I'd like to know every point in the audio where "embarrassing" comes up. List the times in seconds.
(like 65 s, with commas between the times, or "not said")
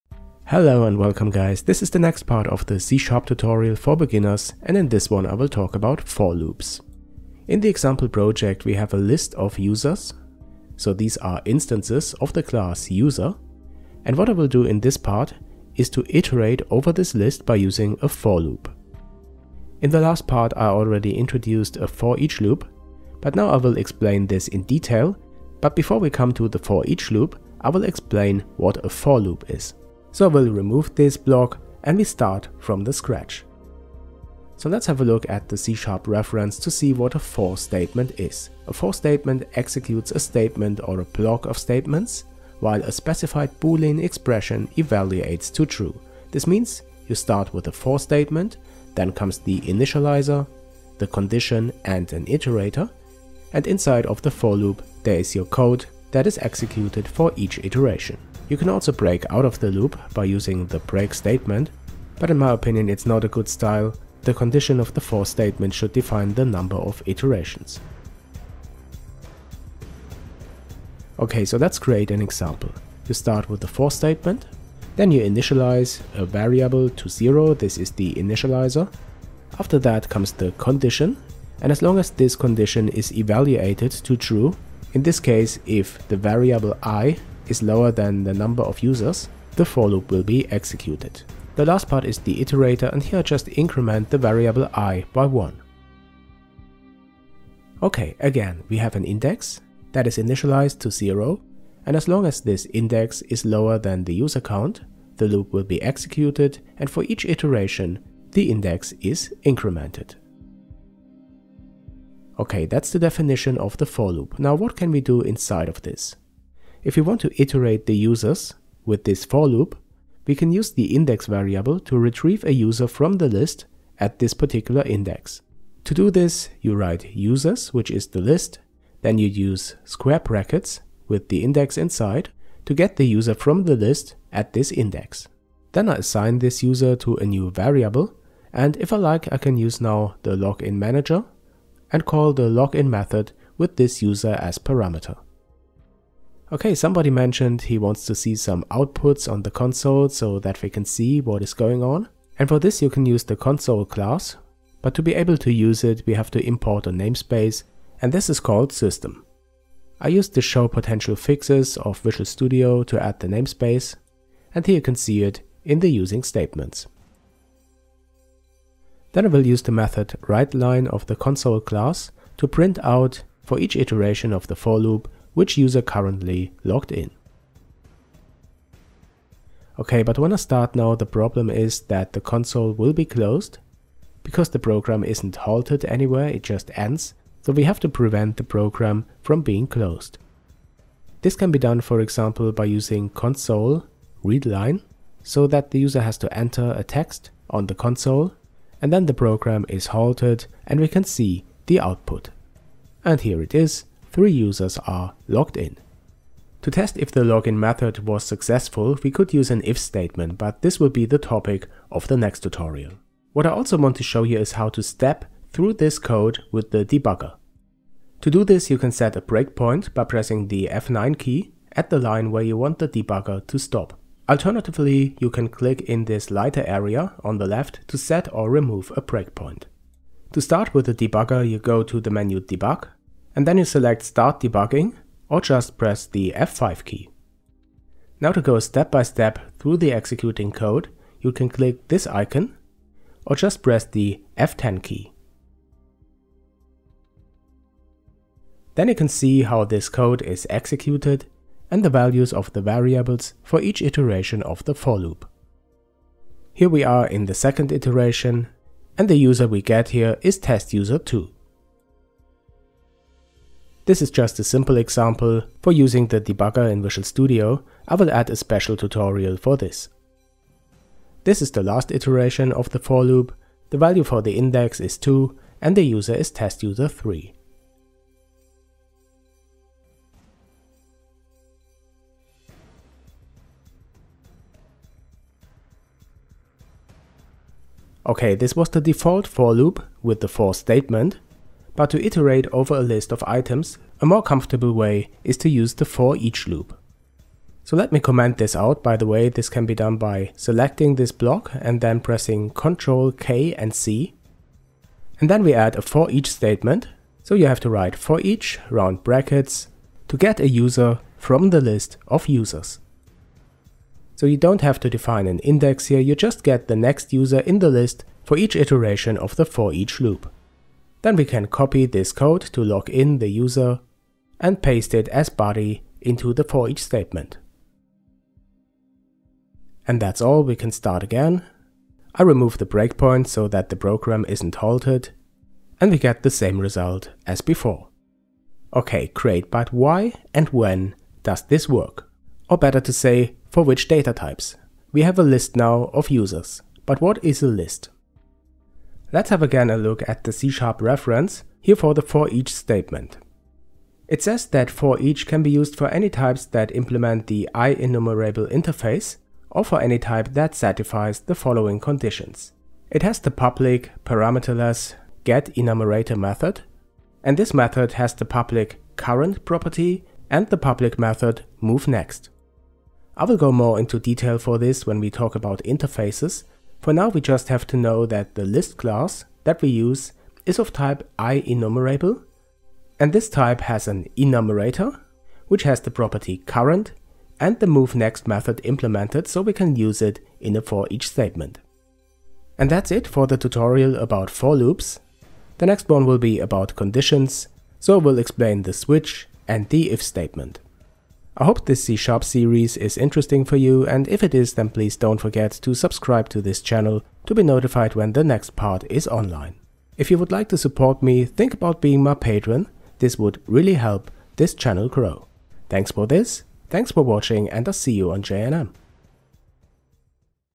not said.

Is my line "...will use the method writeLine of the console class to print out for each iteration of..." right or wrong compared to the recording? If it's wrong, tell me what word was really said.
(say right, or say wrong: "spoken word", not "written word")
right.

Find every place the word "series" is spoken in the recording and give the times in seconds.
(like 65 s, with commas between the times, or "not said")
402 s.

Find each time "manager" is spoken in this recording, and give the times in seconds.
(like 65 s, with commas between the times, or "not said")
140 s.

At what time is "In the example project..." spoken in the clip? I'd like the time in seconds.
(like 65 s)
7 s.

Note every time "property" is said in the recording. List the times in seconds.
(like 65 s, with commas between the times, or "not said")
369 s, 385 s.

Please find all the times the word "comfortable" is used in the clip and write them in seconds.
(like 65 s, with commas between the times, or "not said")
294 s.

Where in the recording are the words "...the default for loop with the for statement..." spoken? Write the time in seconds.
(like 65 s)
288 s.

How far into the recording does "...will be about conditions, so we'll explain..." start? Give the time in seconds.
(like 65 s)
396 s.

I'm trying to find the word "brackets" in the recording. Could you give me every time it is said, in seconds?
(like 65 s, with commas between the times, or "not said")
130 s, 309 s.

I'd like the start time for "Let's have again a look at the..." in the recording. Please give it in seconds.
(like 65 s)
349 s.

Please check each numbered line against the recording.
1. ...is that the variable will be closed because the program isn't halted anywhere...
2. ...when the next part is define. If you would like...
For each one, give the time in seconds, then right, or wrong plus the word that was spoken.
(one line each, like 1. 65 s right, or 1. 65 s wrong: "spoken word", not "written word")
1. 181 s wrong: "console", not "variable"
2. 407 s wrong: "online", not "define".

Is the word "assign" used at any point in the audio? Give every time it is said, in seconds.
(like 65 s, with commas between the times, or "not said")
135 s.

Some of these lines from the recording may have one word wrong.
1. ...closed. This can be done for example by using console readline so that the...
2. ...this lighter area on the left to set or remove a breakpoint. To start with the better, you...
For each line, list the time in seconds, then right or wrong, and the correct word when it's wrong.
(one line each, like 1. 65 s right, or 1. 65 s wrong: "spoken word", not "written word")
1. 189 s right
2. 226 s wrong: "debugger", not "better".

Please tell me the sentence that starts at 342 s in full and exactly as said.
Or better to say, for which data types?